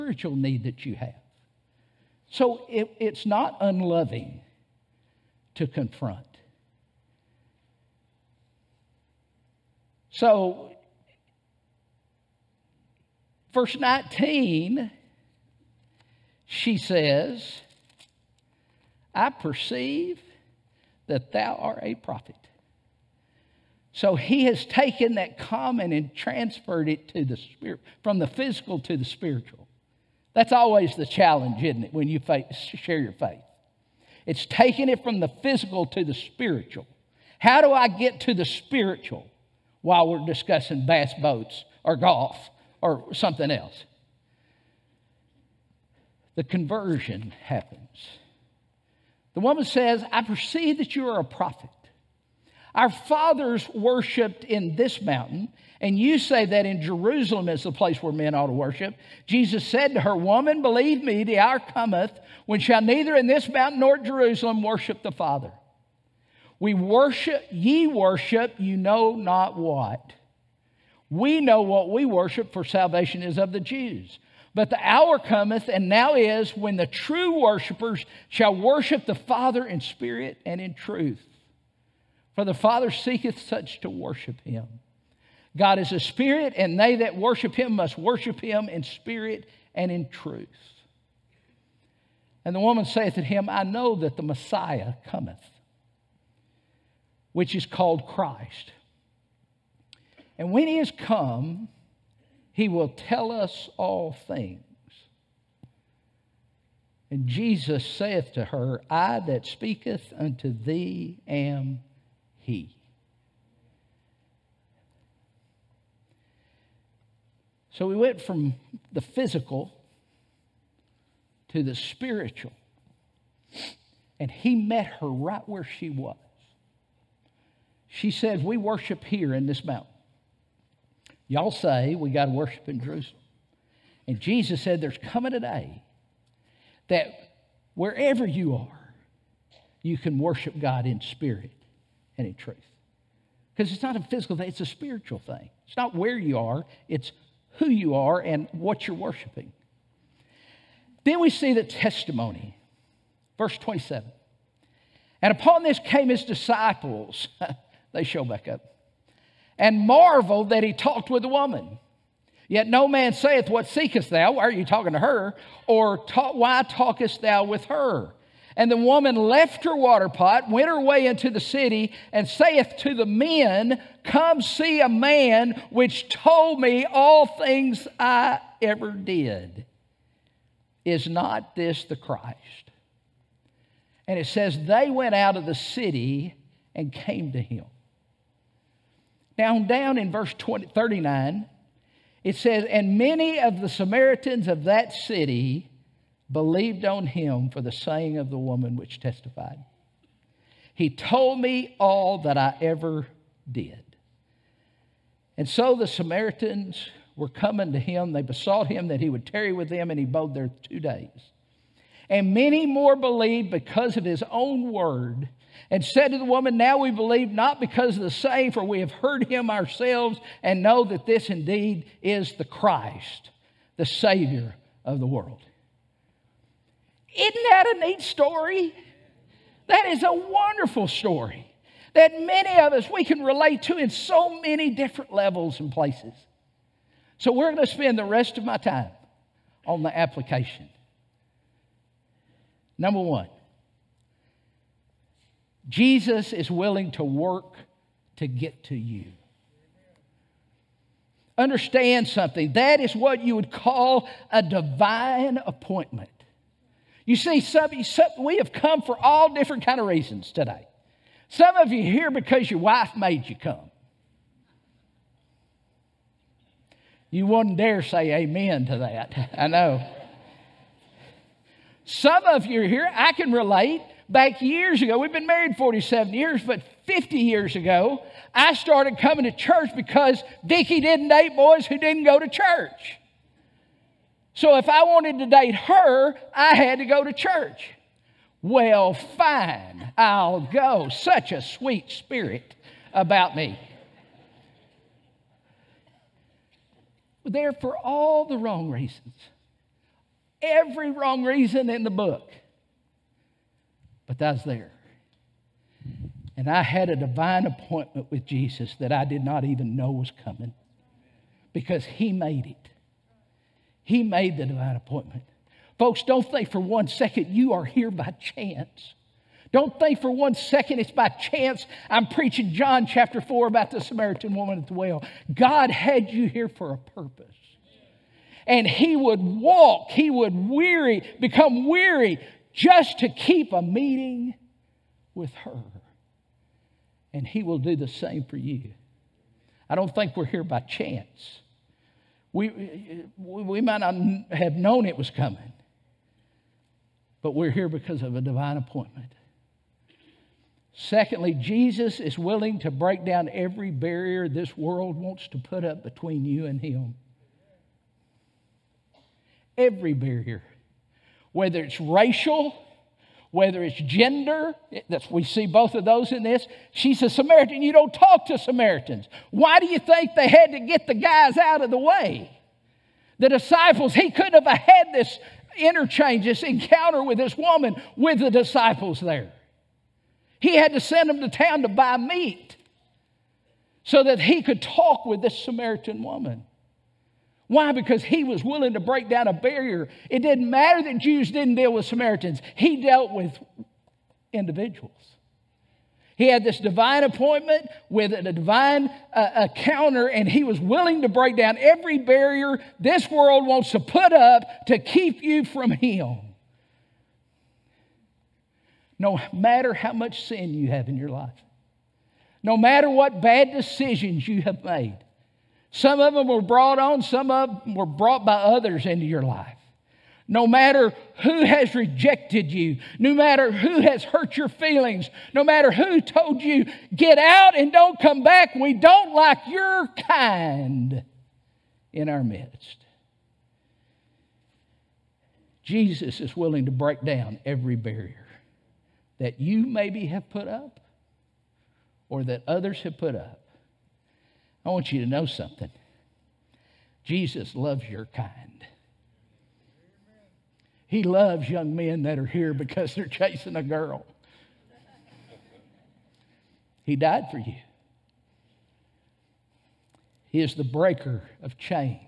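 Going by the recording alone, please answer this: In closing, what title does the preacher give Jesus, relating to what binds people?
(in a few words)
breaker of chains.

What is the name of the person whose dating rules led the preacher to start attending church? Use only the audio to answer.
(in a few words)
Dickie.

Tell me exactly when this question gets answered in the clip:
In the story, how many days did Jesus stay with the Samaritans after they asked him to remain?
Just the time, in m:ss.
3:30.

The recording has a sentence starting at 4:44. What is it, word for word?
So if I wanted to date her, I had to go to church.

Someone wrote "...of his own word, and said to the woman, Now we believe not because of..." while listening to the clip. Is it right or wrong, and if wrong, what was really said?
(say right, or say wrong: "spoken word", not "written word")
right.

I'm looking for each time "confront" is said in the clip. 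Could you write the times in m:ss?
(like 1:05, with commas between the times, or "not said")
0:05.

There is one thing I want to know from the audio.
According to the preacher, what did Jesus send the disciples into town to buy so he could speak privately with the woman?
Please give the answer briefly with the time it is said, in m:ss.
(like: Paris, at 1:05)
meat, at 6:21.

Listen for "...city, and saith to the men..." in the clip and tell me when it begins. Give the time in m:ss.
2:51.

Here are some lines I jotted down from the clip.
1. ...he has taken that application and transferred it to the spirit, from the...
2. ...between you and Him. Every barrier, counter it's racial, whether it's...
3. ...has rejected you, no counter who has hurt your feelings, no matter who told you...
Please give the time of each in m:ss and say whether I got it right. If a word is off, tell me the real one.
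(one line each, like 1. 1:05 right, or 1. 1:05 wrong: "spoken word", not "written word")
1. 0:24 wrong: "common", not "application"
2. 5:55 wrong: "whether", not "counter"
3. 7:01 wrong: "matter", not "counter".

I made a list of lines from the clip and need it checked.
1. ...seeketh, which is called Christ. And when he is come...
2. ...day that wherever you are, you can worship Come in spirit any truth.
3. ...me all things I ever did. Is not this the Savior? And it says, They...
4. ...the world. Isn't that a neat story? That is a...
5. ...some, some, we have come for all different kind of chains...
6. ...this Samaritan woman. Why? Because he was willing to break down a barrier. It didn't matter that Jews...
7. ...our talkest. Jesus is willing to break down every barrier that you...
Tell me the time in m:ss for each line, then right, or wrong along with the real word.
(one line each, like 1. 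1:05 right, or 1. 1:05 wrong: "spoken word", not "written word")
1. 1:35 wrong: "cometh", not "seeketh"
2. 2:15 wrong: "God", not "Come"
3. 2:56 wrong: "Christ", not "Savior"
4. 3:44 right
5. 4:17 wrong: "reasons", not "chains"
6. 6:25 right
7. 7:12 wrong: "midst", not "talkest".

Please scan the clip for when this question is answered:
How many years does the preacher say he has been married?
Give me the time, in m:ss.
4:35.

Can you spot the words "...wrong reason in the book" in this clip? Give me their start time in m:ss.
5:00.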